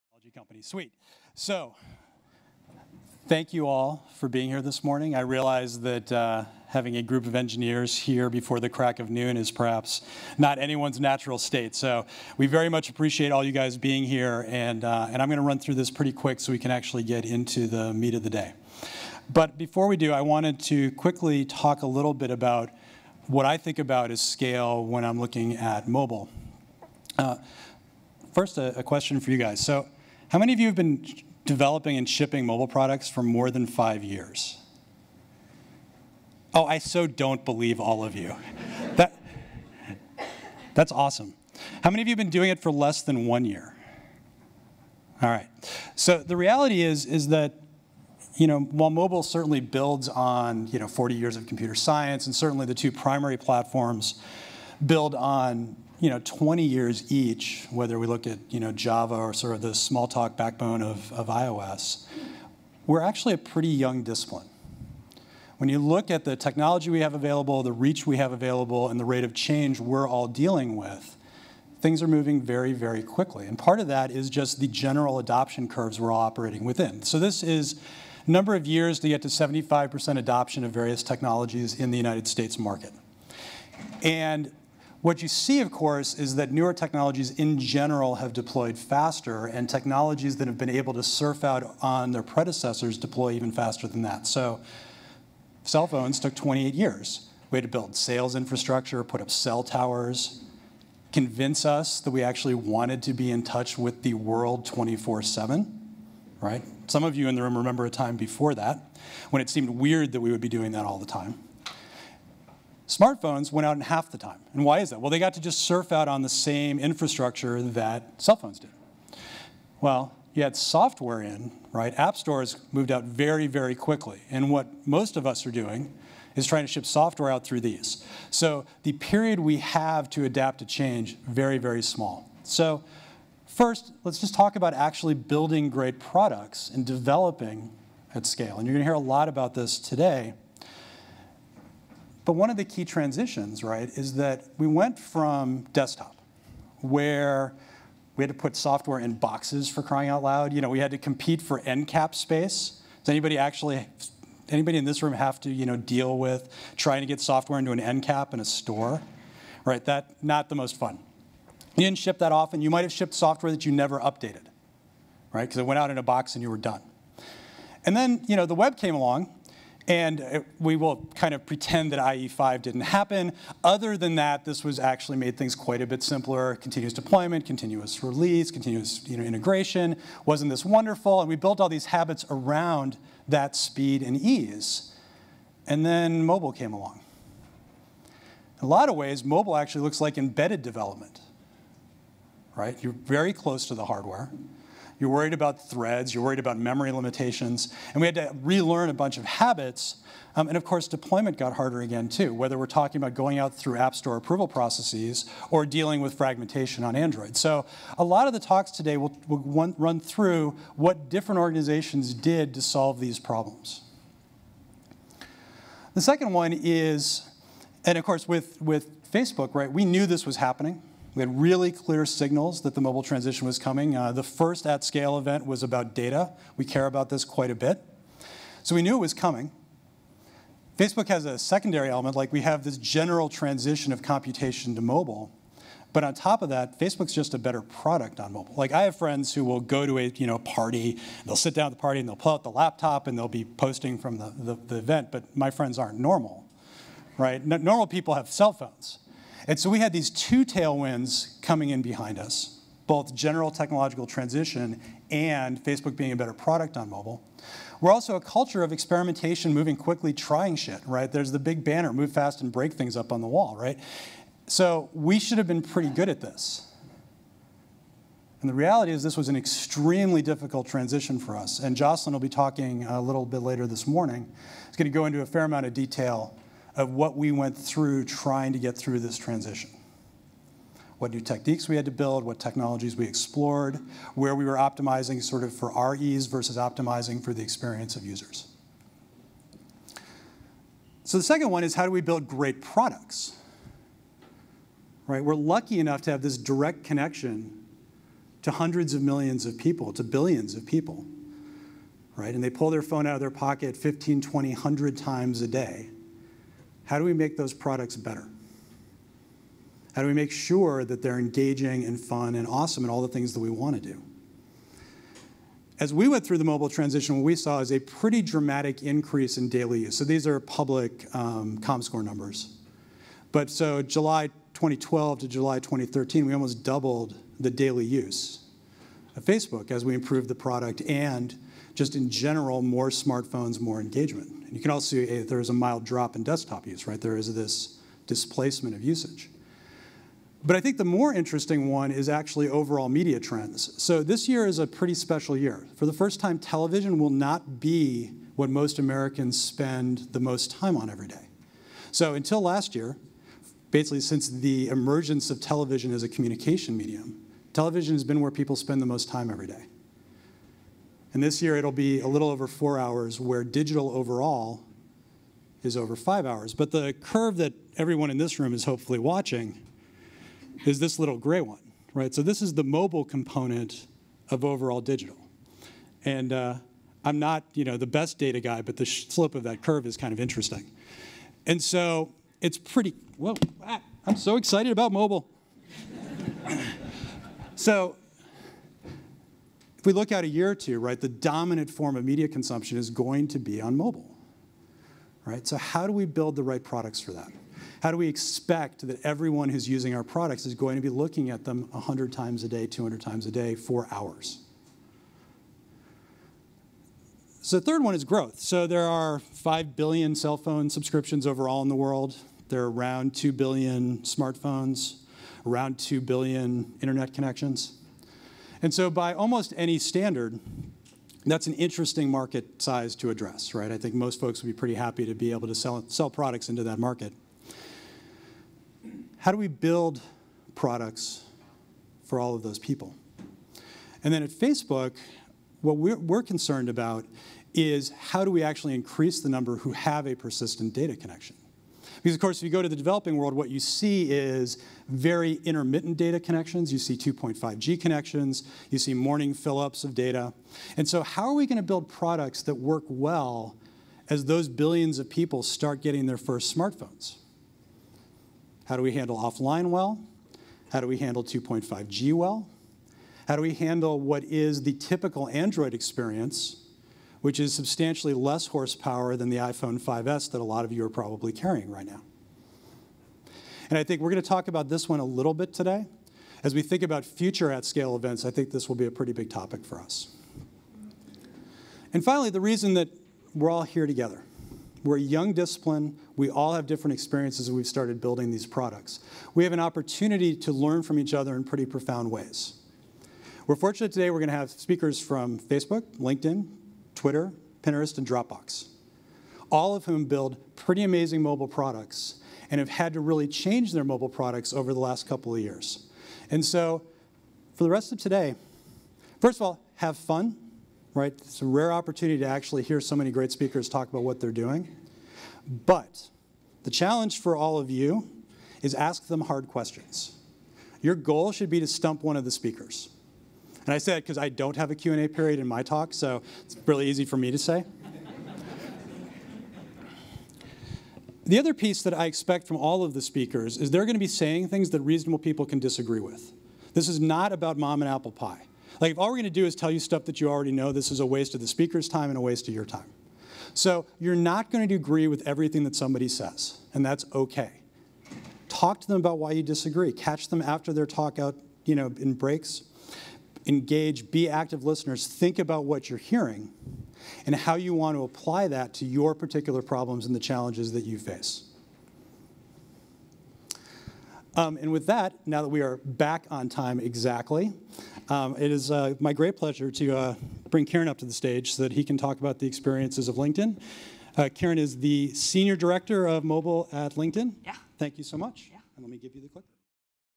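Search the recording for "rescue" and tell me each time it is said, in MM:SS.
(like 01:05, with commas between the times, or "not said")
not said.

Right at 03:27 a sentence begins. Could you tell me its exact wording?
So a lot of the talks today will, will run through what different organizations did to solve these problems.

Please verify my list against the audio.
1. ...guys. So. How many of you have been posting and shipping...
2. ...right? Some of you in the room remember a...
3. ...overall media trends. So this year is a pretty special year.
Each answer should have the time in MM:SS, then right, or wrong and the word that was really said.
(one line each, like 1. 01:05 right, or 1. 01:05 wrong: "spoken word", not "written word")
1. 00:29 wrong: "developing", not "posting"
2. 01:46 right
3. 05:42 right.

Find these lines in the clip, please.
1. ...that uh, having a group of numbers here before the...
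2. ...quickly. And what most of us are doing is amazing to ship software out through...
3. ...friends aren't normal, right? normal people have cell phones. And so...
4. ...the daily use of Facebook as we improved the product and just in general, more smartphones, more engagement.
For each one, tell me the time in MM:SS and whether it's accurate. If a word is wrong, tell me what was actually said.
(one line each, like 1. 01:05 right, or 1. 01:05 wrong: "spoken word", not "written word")
1. 00:05 wrong: "engineers", not "numbers"
2. 02:03 wrong: "trying", not "amazing"
3. 04:05 right
4. 05:27 right.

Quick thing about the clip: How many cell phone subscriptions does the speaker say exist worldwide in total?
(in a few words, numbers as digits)
5 billion.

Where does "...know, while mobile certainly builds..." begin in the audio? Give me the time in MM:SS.
00:48.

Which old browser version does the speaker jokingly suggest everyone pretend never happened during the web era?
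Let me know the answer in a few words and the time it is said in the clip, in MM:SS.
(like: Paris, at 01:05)
IE5, at 02:51.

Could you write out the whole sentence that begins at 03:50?
Facebook has a secondary element, like we have this general transition of computation to mobile.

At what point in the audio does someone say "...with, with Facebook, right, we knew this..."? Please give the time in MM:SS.
03:38.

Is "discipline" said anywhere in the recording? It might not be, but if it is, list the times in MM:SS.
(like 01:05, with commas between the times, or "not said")
01:04, 08:05.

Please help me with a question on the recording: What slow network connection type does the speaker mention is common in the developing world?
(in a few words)
2.5G.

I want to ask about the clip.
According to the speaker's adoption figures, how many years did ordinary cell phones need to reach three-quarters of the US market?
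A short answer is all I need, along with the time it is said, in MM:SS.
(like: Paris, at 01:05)
28 years, at 01:36.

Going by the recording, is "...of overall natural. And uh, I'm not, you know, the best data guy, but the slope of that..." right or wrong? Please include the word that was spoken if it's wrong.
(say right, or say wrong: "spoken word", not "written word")
wrong: "digital", not "natural".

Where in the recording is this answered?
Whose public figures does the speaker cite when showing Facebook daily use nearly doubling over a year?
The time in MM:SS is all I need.
05:21.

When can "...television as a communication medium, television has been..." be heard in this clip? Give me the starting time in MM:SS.
05:55.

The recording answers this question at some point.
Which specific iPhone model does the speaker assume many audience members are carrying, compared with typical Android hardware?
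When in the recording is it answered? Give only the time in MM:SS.
07:49.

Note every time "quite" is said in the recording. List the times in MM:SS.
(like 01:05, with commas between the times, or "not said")
02:55, 03:47.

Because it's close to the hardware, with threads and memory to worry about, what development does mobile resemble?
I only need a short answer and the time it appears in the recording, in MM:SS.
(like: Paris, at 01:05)
embedded development, at 03:10.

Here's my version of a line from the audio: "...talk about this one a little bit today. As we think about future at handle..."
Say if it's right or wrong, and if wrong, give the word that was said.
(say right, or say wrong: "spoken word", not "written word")
wrong: "scale", not "handle".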